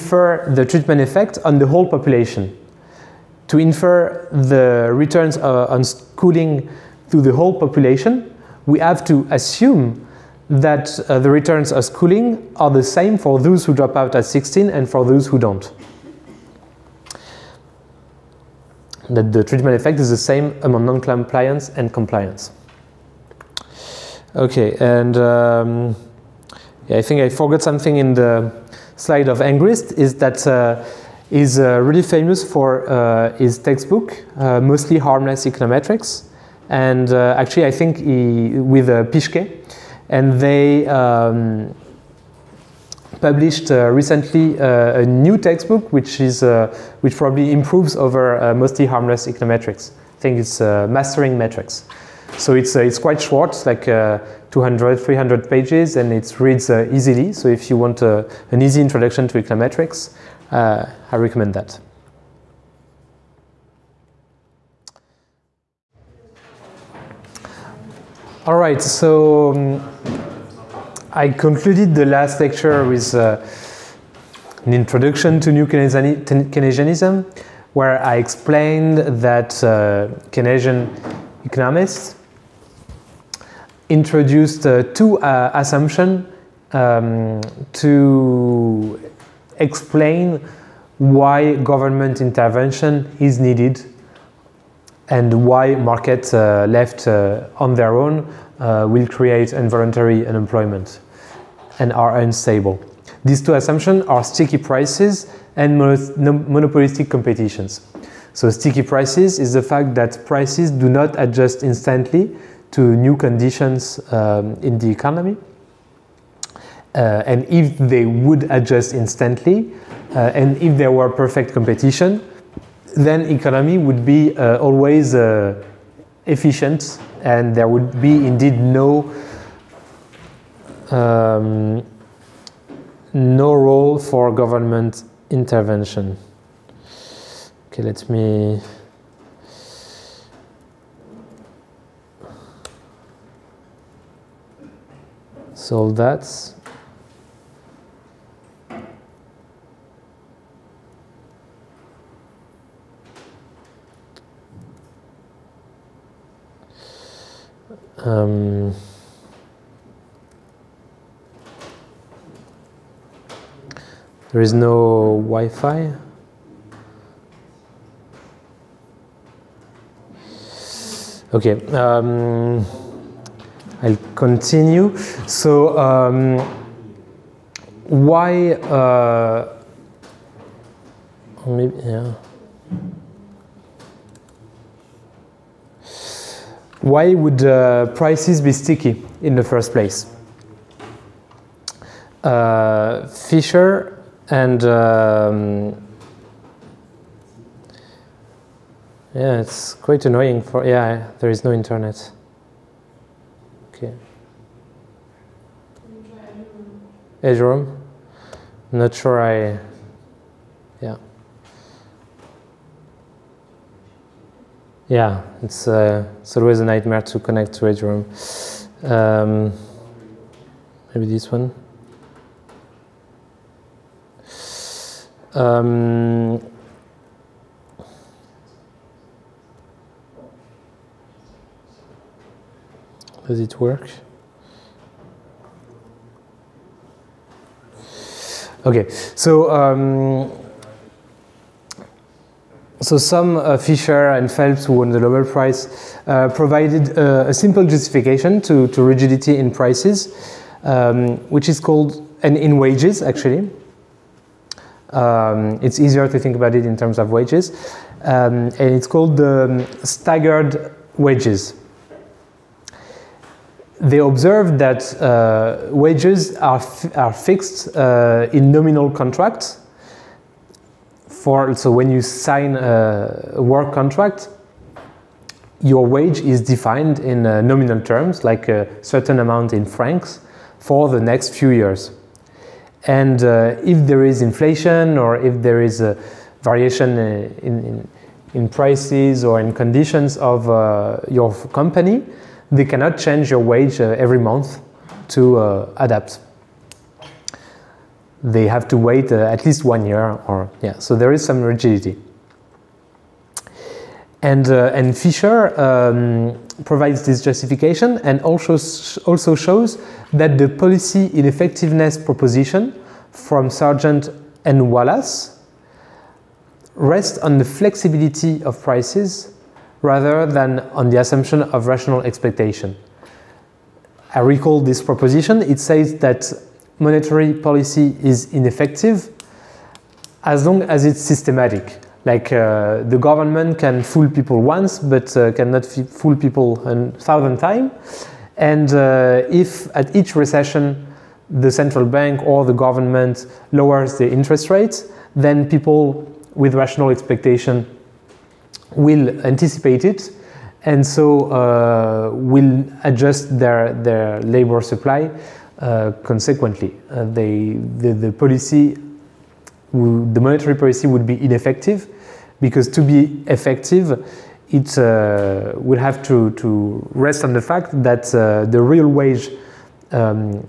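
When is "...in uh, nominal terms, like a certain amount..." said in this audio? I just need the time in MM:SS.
04:36.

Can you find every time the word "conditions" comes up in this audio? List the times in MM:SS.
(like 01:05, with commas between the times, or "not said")
01:53, 04:49.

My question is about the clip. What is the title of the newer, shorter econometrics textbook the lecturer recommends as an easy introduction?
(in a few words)
Mastering Metrics.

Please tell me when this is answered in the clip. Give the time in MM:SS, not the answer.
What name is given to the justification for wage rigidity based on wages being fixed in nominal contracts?
04:19.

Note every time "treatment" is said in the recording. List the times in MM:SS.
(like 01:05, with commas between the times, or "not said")
00:00, 00:19.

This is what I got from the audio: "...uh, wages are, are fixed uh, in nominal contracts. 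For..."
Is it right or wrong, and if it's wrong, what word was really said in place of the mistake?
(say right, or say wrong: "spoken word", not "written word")
right.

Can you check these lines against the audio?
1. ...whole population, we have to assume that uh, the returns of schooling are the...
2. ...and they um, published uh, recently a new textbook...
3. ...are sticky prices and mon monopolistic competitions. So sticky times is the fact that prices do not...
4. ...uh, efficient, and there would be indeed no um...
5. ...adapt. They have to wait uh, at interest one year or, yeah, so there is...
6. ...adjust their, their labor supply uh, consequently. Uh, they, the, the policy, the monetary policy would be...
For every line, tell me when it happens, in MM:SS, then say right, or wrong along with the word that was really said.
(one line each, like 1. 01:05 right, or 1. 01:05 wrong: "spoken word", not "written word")
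1. 00:07 right
2. 00:40 right
3. 01:44 wrong: "prices", not "times"
4. 02:05 right
5. 04:55 wrong: "least", not "interest"
6. 05:52 right.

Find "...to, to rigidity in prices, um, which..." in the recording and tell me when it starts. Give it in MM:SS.
04:08.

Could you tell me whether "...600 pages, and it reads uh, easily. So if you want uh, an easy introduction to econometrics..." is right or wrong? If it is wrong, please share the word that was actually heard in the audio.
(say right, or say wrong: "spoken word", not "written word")
wrong: "300", not "600".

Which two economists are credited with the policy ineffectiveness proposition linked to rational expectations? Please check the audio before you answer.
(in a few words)
Sargent and Wallace.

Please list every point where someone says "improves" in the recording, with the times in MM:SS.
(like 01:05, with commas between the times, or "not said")
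00:47.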